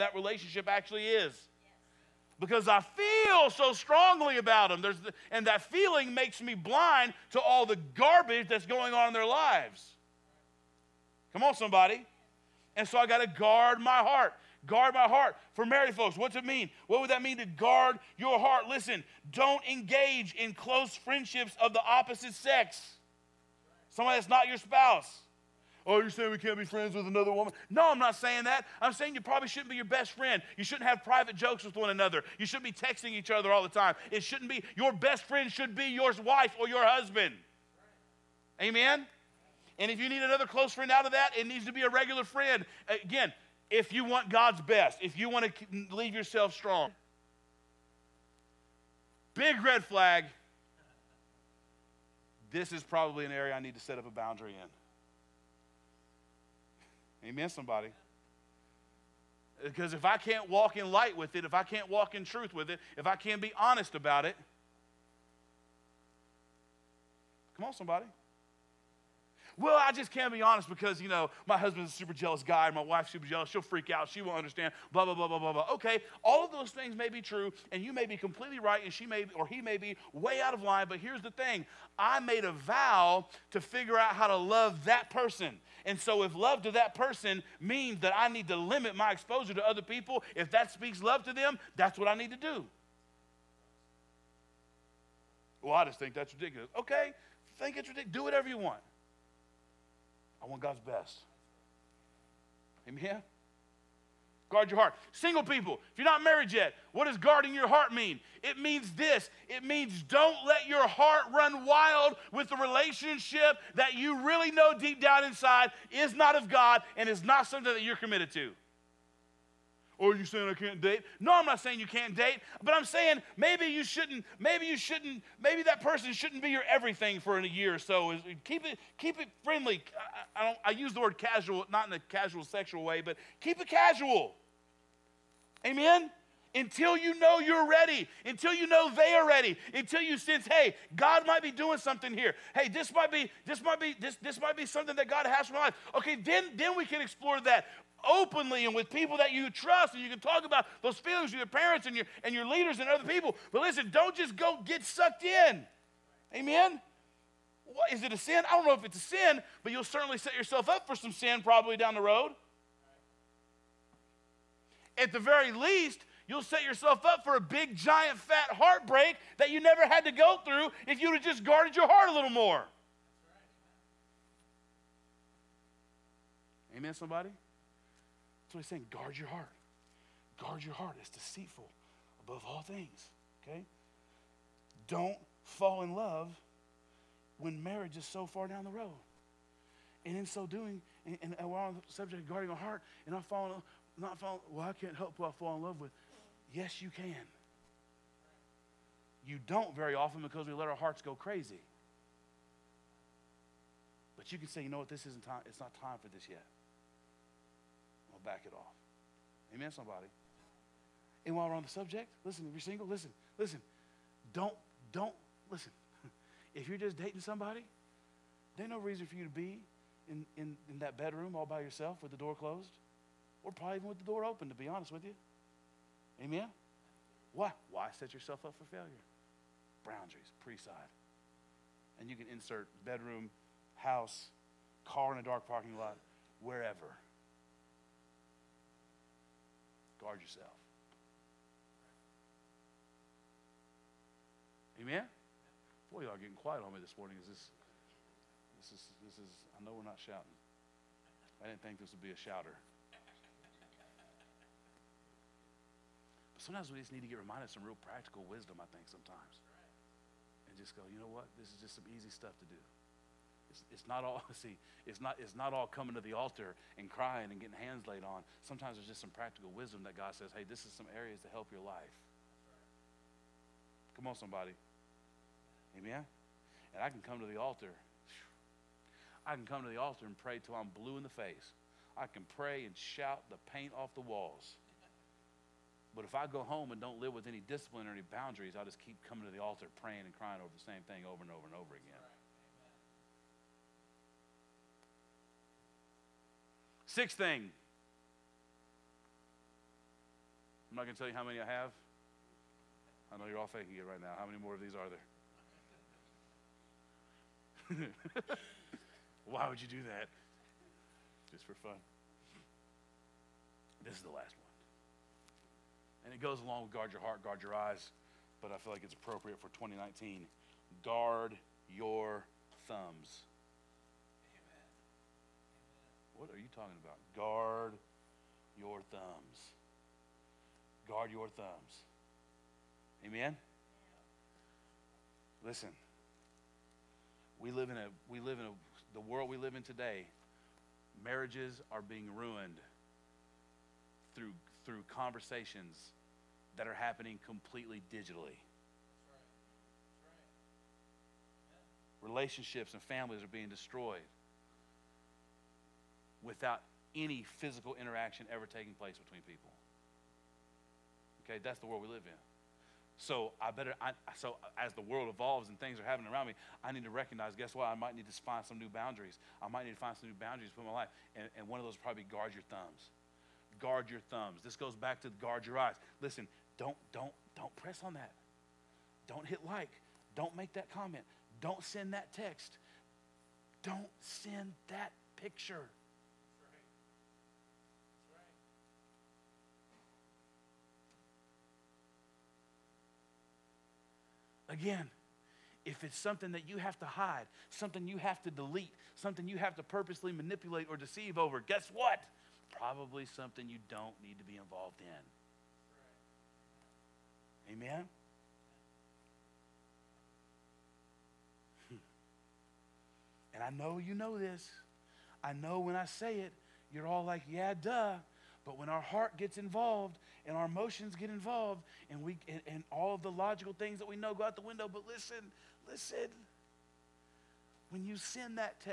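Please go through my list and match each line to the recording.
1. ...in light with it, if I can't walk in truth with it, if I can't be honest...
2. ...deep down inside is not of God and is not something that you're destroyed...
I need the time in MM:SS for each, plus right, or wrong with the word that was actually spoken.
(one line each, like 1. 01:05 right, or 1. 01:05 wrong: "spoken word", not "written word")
1. 01:00 right
2. 01:54 wrong: "committed", not "destroyed".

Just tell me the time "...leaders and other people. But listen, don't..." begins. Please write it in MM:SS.
02:32.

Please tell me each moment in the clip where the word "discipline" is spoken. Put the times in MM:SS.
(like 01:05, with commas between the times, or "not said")
04:47.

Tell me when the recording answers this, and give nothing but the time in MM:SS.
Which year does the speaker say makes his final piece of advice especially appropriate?
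05:19.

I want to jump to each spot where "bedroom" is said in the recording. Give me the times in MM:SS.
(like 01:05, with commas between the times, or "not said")
03:40, 03:52.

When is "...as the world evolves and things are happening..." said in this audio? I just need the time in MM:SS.
06:04.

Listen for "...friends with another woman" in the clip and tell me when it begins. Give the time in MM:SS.
00:26.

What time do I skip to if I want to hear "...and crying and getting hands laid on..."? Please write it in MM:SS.
04:26.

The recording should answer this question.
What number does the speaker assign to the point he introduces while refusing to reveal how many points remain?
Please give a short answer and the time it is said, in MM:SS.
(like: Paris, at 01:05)
6, at 04:56.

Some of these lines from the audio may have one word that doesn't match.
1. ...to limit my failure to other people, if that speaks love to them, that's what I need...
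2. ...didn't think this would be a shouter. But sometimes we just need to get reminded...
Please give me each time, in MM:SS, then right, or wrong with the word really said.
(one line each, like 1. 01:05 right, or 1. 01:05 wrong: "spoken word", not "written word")
1. 01:28 wrong: "exposure", not "failure"
2. 04:11 right.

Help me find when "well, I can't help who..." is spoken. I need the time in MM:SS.
03:14.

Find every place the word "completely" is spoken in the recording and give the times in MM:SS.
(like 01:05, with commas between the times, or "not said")
01:18, 05:47.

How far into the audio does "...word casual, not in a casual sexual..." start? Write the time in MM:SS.
02:10.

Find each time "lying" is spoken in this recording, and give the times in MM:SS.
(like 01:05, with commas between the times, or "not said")
not said.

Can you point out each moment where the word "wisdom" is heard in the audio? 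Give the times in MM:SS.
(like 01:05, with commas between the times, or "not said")
04:18, 04:29.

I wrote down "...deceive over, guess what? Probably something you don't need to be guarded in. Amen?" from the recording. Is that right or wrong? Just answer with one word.
wrong.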